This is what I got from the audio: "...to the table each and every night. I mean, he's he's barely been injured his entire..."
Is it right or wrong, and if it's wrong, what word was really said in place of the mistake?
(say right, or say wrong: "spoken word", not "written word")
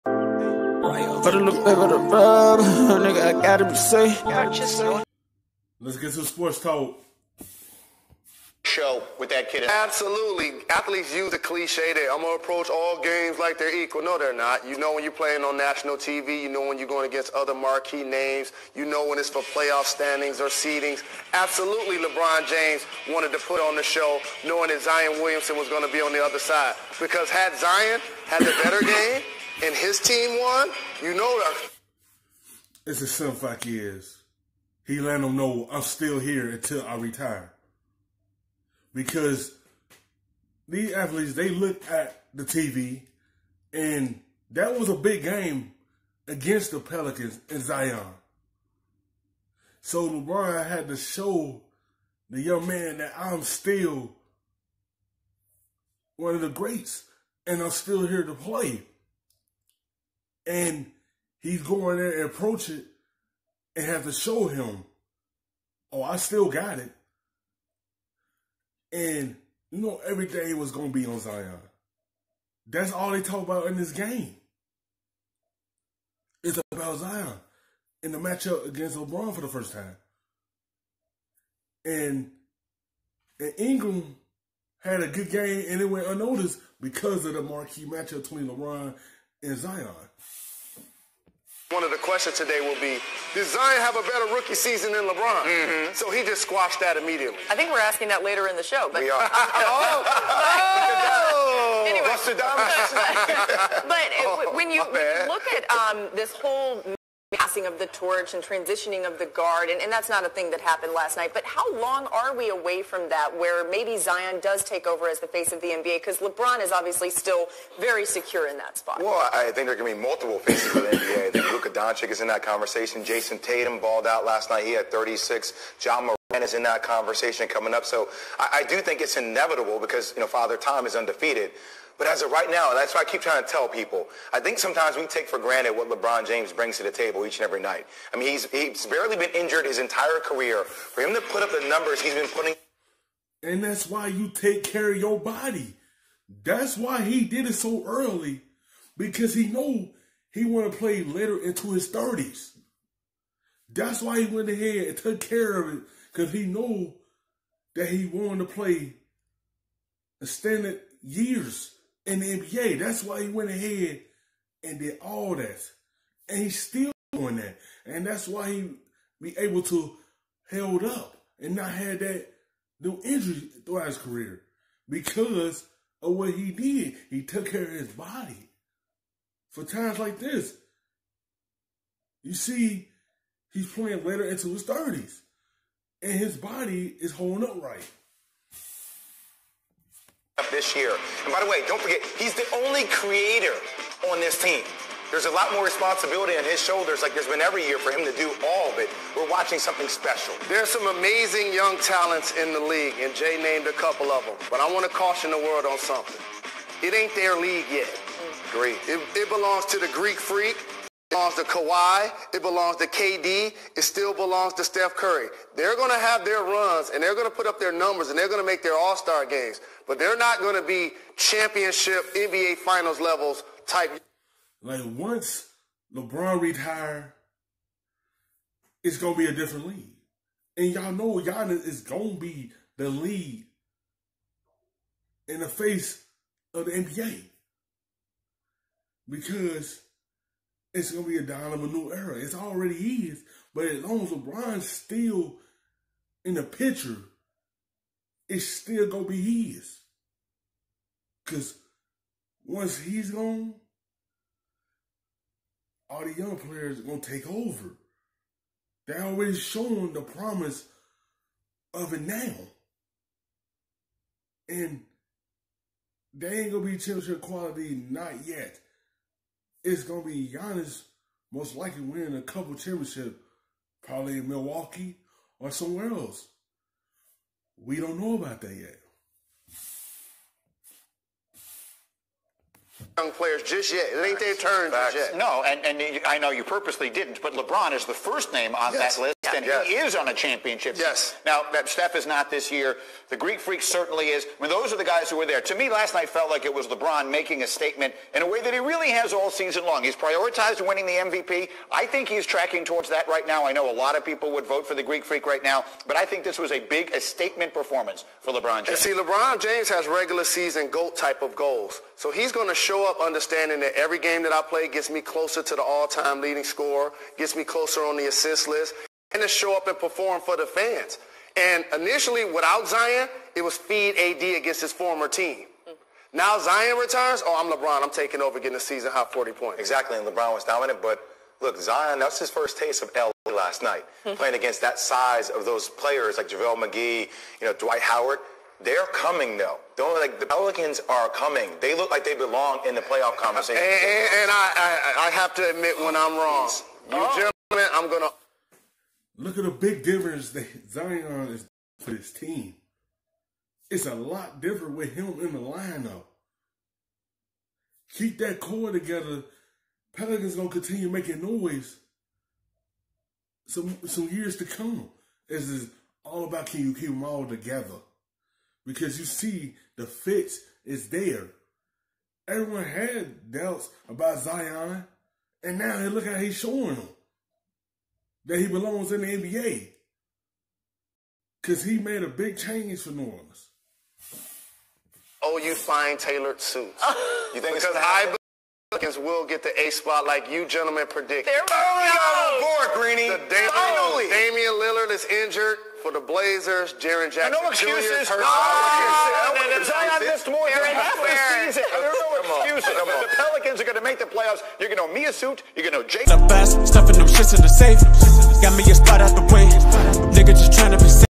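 right.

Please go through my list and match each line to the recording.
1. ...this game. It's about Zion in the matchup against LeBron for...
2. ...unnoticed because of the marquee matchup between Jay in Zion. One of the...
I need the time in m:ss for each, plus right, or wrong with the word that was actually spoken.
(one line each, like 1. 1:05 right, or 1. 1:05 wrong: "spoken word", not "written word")
1. 1:13 right
2. 1:26 wrong: "LeBron", not "Jay".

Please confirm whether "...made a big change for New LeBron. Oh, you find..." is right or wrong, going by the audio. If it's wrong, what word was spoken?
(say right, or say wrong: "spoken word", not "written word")
wrong: "Orleans", not "LeBron".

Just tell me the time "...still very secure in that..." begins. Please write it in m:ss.
1:57.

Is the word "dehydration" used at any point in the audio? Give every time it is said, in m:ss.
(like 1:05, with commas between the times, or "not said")
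not said.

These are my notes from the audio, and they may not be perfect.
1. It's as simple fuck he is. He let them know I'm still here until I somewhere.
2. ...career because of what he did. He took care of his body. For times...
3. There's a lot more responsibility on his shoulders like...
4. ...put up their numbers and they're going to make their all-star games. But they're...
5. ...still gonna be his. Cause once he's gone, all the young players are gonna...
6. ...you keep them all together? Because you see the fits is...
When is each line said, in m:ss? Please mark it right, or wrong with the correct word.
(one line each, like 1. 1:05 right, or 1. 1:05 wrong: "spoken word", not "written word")
1. 0:32 wrong: "retire", not "somewhere"
2. 2:53 right
3. 3:15 right
4. 3:37 right
5. 4:08 right
6. 6:06 right.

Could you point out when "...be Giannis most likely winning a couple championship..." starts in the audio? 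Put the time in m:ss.
4:30.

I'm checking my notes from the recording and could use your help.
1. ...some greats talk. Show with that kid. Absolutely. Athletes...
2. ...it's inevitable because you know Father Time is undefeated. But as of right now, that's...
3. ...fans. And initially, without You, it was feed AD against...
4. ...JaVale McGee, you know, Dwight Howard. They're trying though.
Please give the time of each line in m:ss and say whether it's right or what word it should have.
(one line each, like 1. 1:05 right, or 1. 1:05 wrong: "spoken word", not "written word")
1. 0:06 wrong: "sports", not "greats"
2. 2:09 right
3. 5:20 wrong: "Zion", not "You"
4. 5:36 wrong: "coming", not "trying".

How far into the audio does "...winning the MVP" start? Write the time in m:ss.
5:00.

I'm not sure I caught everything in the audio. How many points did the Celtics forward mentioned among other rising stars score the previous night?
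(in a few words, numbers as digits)
36.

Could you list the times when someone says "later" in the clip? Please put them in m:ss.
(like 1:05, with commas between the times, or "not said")
1:38, 2:31, 3:04.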